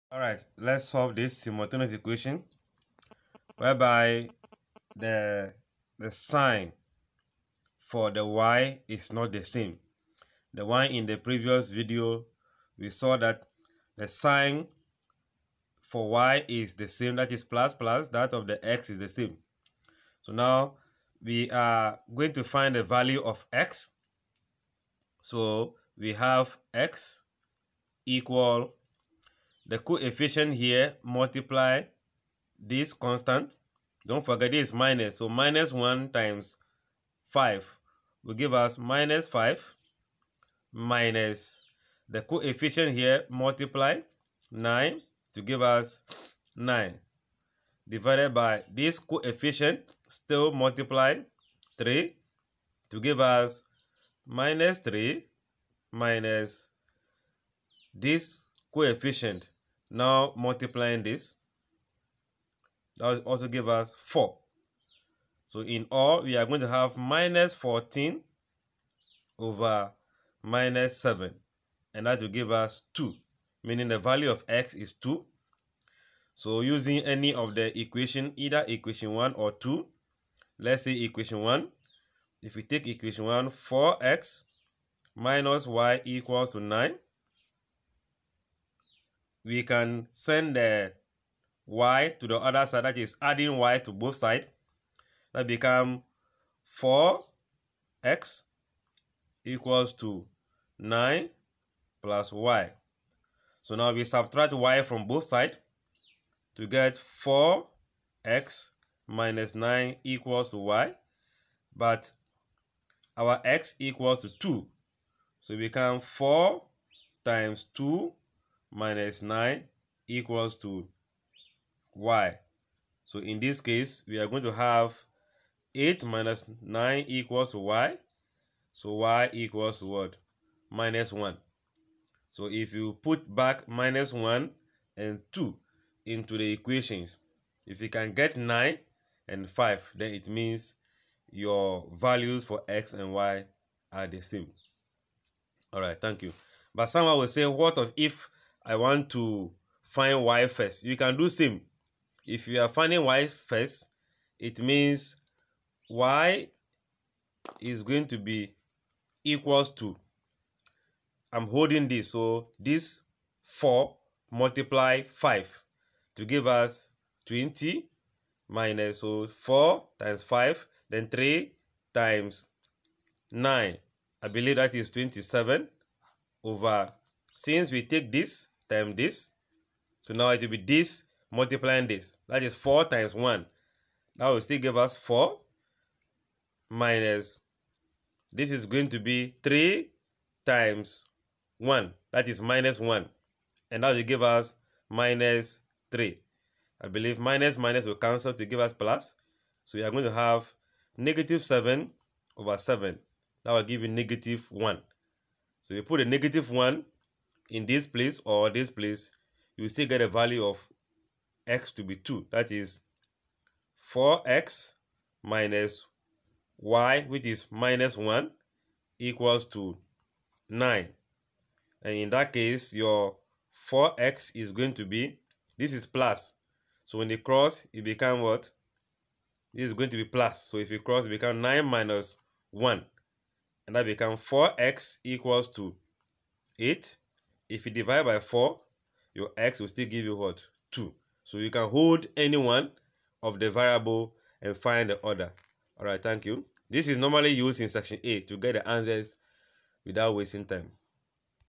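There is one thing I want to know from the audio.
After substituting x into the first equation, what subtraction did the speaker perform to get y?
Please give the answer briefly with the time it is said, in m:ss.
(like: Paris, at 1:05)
8 - 9, at 2:05.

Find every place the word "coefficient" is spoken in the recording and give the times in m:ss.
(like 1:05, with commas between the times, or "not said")
0:29, 0:42, 0:48, 0:58.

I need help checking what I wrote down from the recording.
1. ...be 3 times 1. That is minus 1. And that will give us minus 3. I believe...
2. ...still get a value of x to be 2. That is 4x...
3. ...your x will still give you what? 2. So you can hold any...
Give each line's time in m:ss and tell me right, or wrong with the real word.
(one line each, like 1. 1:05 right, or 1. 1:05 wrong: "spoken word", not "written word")
1. 3:08 right
2. 3:29 right
3. 3:59 right.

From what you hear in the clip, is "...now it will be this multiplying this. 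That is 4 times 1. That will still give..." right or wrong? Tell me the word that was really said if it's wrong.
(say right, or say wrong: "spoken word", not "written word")
right.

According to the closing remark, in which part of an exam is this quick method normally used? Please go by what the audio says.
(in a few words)
Section A.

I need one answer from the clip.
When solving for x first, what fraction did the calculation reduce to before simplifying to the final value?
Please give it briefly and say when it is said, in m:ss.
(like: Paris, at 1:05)
-14/-7, at 1:06.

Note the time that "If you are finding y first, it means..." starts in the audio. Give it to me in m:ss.
2:32.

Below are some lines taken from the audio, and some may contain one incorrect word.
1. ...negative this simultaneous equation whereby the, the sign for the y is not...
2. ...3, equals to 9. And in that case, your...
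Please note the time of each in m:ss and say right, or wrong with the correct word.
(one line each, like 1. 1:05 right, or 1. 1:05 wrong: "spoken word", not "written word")
1. 0:00 wrong: "solve", not "negative"
2. 3:37 wrong: "1", not "3".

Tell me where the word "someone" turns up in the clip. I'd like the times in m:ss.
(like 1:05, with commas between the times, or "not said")
2:26.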